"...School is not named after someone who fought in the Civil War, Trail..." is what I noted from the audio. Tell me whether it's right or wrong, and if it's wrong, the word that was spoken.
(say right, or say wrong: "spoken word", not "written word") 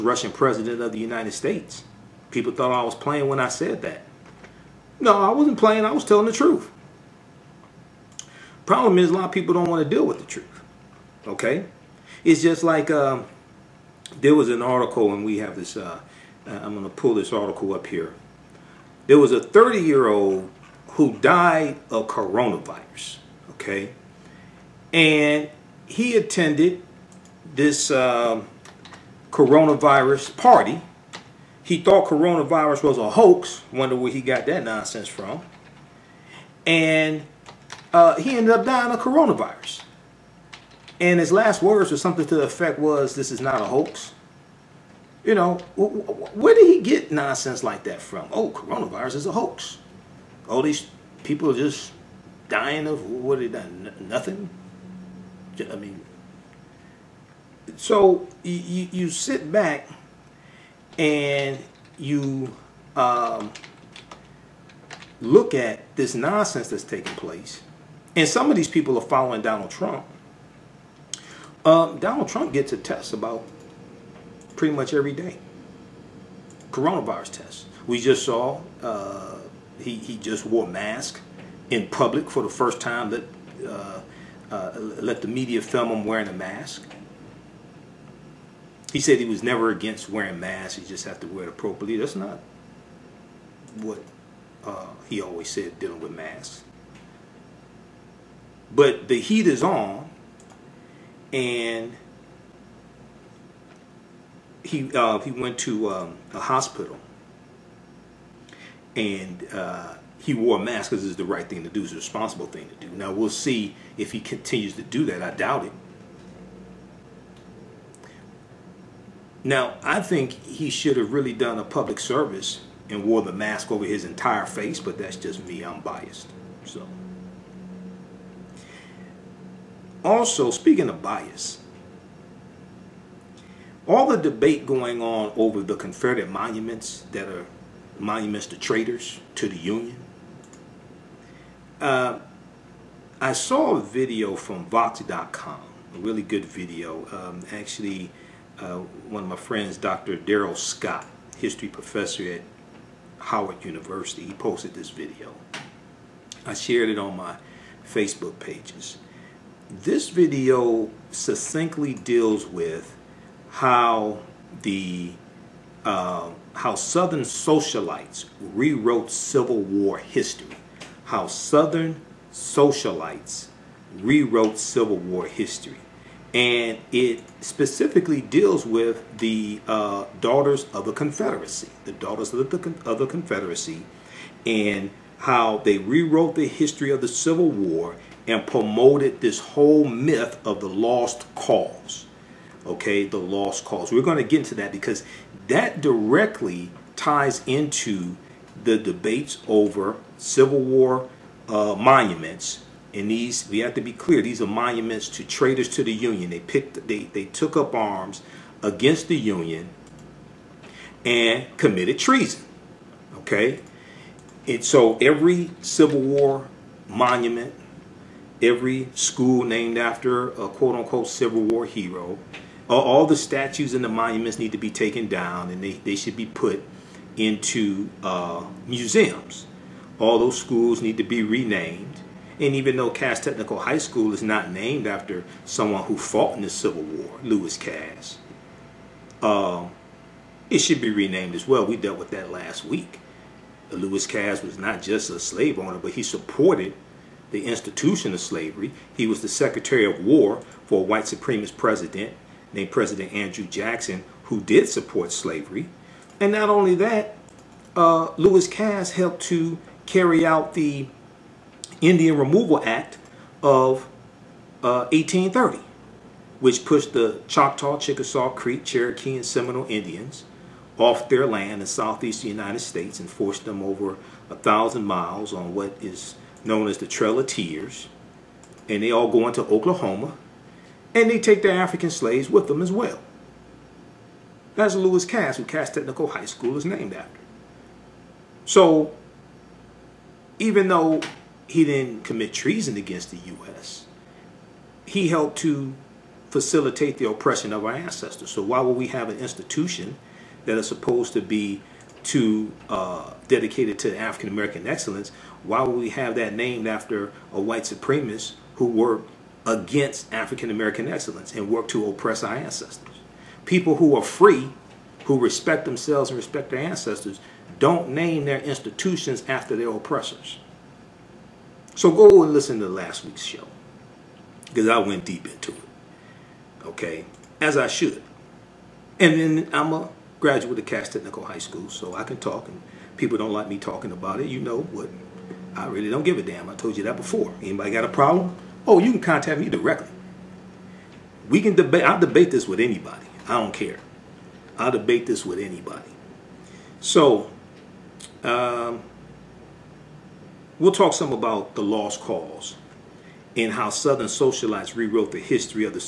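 wrong: "Lewis", not "Trail".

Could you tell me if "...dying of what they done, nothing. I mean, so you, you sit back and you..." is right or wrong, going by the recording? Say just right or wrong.
right.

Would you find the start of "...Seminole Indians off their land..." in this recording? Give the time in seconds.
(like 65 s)
269 s.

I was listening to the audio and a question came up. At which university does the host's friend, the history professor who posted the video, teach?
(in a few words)
Howard University.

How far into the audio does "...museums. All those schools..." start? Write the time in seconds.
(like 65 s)
228 s.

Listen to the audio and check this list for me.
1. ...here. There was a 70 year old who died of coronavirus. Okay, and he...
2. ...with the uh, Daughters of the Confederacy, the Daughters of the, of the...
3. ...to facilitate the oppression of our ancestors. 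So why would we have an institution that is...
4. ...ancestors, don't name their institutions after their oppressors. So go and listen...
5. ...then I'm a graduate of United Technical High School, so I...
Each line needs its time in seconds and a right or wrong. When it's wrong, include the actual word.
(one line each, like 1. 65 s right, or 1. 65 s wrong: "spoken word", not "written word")
1. 17 s wrong: "30", not "70"
2. 178 s right
3. 295 s right
4. 316 s right
5. 329 s wrong: "Cass", not "United".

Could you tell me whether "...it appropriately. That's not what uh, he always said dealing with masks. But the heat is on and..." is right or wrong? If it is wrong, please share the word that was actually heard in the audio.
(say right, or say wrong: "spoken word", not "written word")
right.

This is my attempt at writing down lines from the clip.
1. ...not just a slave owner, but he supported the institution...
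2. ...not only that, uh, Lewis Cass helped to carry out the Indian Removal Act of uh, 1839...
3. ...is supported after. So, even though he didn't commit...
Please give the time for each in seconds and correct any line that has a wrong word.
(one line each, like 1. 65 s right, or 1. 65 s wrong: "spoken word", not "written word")
1. 244 s right
2. 256 s wrong: "1830", not "1839"
3. 286 s wrong: "named", not "supported".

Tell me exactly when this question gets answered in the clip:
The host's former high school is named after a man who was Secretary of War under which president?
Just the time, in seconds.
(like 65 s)
253 s.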